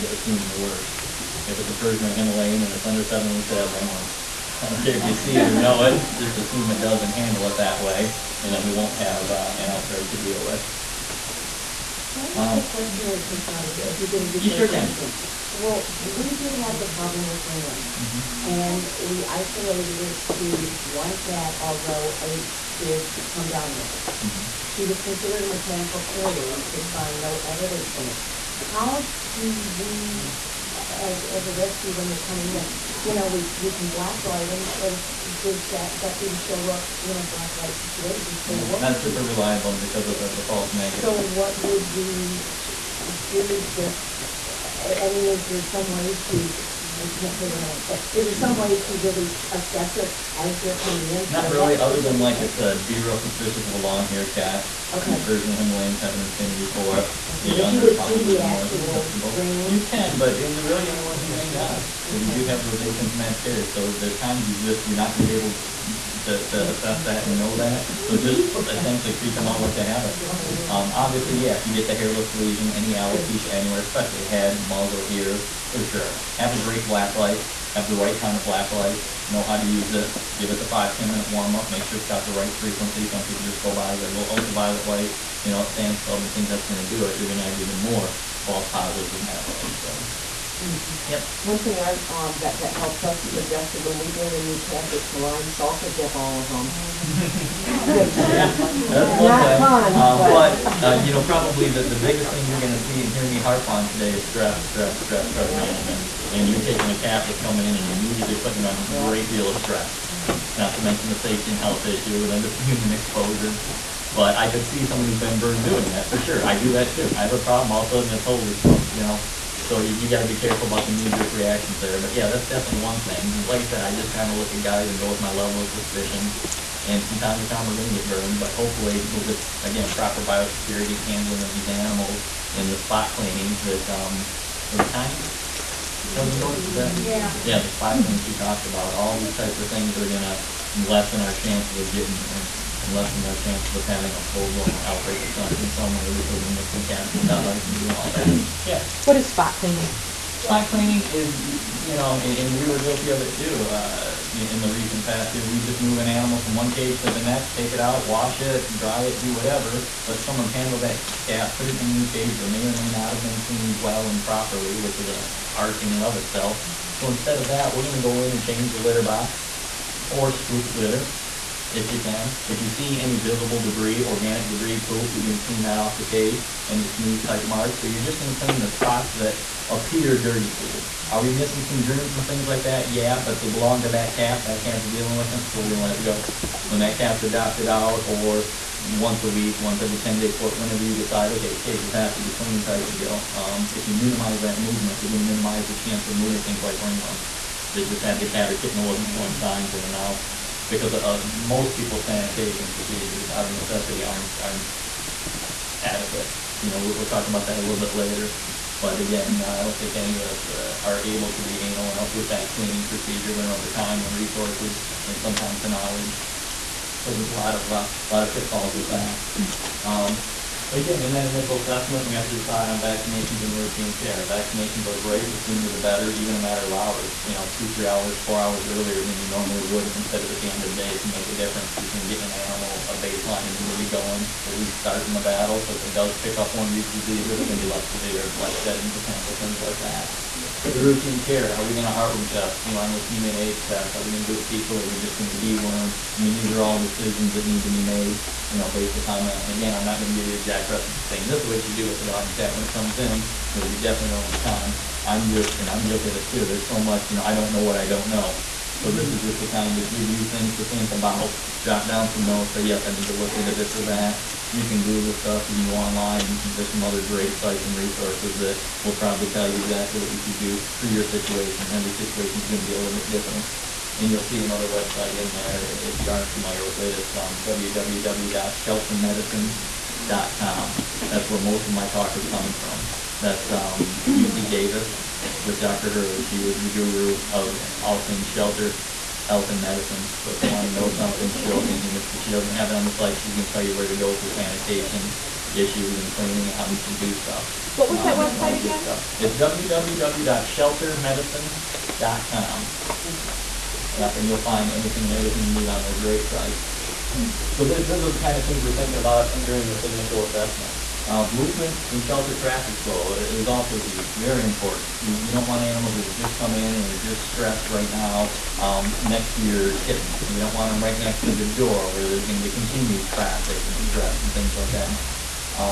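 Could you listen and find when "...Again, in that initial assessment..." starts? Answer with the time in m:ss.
3:40.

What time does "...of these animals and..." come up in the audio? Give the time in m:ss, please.
2:11.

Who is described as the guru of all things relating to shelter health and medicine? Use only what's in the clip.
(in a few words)
Dr. Hurley.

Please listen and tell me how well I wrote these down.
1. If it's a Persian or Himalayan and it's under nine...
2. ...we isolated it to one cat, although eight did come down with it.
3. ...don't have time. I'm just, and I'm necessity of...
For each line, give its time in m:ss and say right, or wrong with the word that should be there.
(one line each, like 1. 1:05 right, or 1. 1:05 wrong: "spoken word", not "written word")
1. 0:01 wrong: "seven", not "nine"
2. 0:19 right
3. 4:14 wrong: "guilty", not "necessity".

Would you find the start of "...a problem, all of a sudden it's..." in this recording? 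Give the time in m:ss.
1:57.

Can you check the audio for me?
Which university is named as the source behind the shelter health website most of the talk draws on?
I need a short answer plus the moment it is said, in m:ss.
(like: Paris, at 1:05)
UC Davis, at 4:44.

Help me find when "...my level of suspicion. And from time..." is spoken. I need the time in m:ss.
2:05.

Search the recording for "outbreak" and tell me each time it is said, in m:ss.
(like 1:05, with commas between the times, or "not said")
0:09, 2:24.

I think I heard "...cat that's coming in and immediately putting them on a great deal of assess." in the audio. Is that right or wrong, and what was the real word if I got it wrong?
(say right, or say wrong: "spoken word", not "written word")
wrong: "stress", not "assess".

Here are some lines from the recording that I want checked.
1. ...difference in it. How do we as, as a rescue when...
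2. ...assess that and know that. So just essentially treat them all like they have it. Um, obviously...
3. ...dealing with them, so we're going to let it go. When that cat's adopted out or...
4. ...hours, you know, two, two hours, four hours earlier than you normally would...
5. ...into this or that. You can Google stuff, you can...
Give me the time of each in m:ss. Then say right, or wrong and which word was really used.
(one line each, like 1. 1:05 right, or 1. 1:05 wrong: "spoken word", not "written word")
1. 0:27 wrong: "evidence", not "difference"
2. 1:06 right
3. 3:04 right
4. 3:46 wrong: "three", not "two"
5. 4:23 right.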